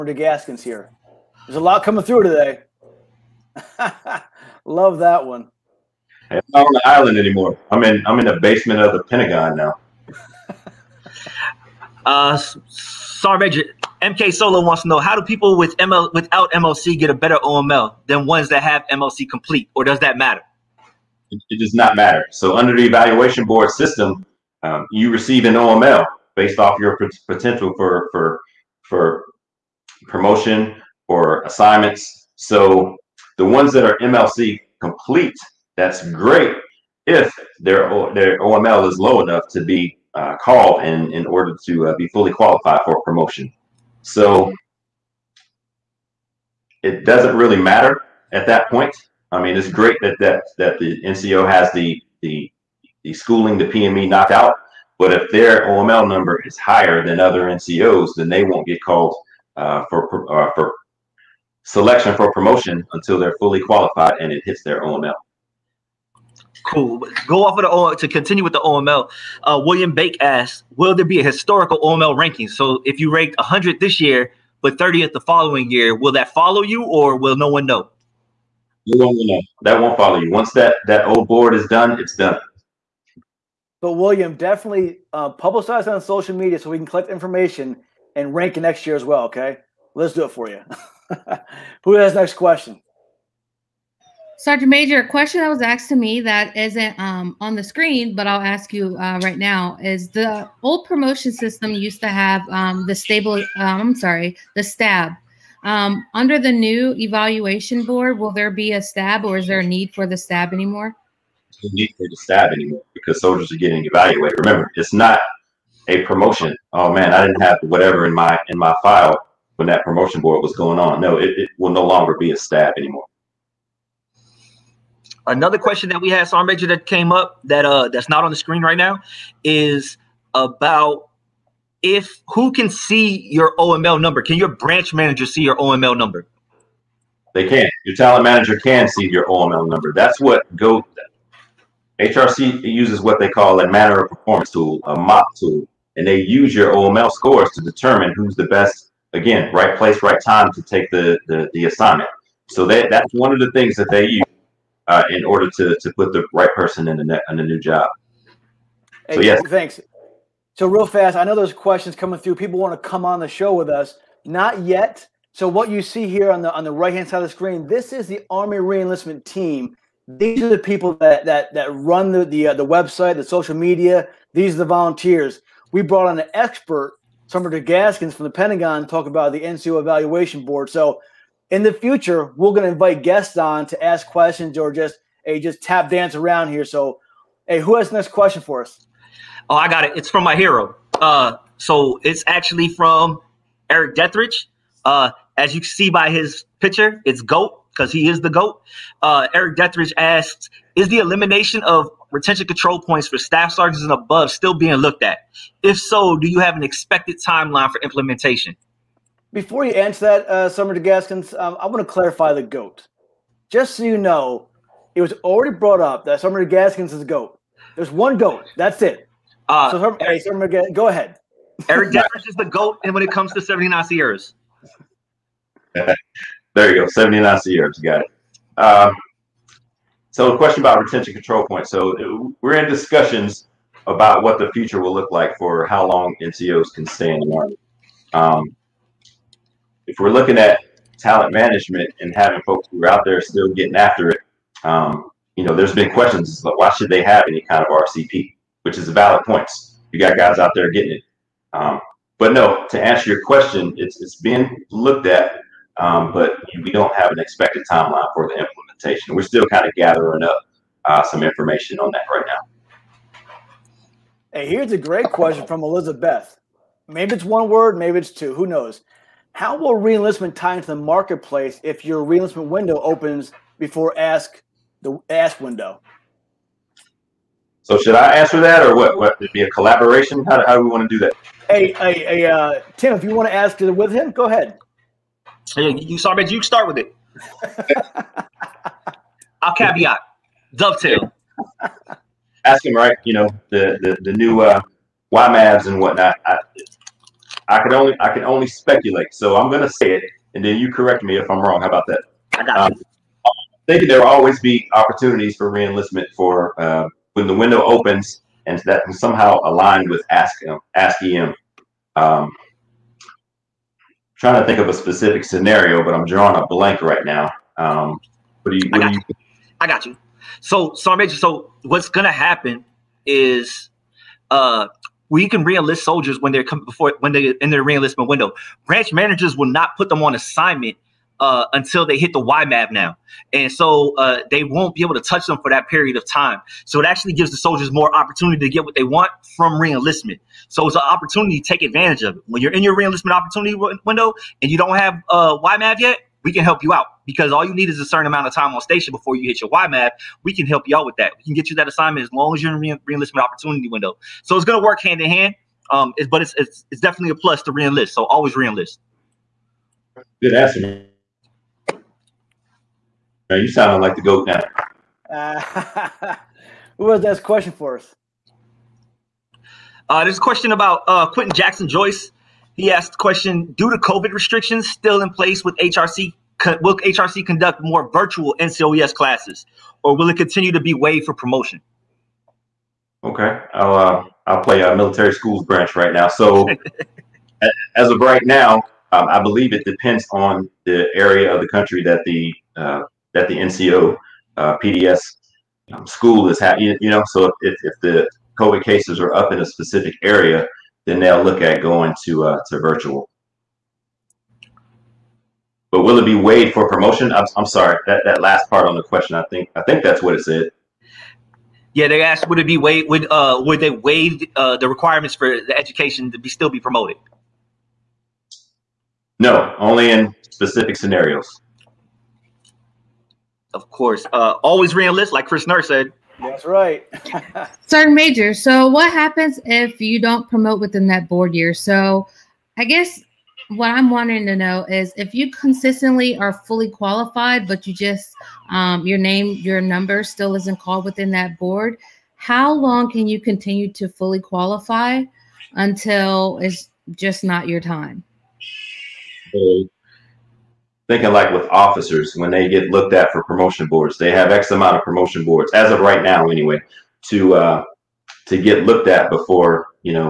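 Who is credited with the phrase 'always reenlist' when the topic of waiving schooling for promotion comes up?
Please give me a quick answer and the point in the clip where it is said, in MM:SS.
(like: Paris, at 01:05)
Chris Nurse, at 07:05.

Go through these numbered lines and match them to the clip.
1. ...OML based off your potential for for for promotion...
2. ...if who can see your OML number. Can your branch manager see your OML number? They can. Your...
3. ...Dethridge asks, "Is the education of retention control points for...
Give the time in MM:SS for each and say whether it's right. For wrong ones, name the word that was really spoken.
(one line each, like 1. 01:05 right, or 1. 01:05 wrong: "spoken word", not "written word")
1. 00:25 right
2. 02:11 right
3. 03:19 wrong: "elimination", not "education".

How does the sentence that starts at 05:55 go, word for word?
Um, it's, but it's, it's, it's definitely a plus to reenlist.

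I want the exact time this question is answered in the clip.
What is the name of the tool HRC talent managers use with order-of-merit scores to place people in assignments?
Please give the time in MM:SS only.
02:23.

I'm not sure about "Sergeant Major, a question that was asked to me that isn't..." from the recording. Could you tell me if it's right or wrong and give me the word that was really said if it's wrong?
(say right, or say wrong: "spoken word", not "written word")
right.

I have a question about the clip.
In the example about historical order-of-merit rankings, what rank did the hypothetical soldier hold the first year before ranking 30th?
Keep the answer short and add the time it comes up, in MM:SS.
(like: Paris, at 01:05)
100, at 01:13.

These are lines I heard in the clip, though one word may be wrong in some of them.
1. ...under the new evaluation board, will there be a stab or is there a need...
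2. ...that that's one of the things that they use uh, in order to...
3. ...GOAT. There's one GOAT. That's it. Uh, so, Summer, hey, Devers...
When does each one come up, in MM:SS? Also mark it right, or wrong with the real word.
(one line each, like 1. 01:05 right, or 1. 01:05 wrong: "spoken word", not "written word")
1. 01:46 right
2. 02:32 right
3. 03:37 wrong: "Summer", not "Devers".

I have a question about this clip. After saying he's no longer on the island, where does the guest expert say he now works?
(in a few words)
basement of the Pentagon.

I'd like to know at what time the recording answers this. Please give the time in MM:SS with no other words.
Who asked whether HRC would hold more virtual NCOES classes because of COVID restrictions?
06:11.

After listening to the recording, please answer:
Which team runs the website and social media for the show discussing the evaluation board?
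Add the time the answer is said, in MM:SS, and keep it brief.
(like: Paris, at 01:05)
Army reenlistment team, at 02:48.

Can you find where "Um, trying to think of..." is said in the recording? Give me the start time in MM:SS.
05:11.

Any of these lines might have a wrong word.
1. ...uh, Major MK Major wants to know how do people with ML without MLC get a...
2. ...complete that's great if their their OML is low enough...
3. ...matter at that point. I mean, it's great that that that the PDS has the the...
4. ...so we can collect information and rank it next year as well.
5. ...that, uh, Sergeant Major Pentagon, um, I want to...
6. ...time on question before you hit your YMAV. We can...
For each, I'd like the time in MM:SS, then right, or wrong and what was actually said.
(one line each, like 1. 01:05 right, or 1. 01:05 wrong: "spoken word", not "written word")
1. 00:12 wrong: "Solo", not "Major"
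2. 00:34 right
3. 00:47 wrong: "NCO", not "PDS"
4. 01:26 right
5. 03:30 wrong: "Gaskins", not "Pentagon"
6. 05:48 wrong: "station", not "question".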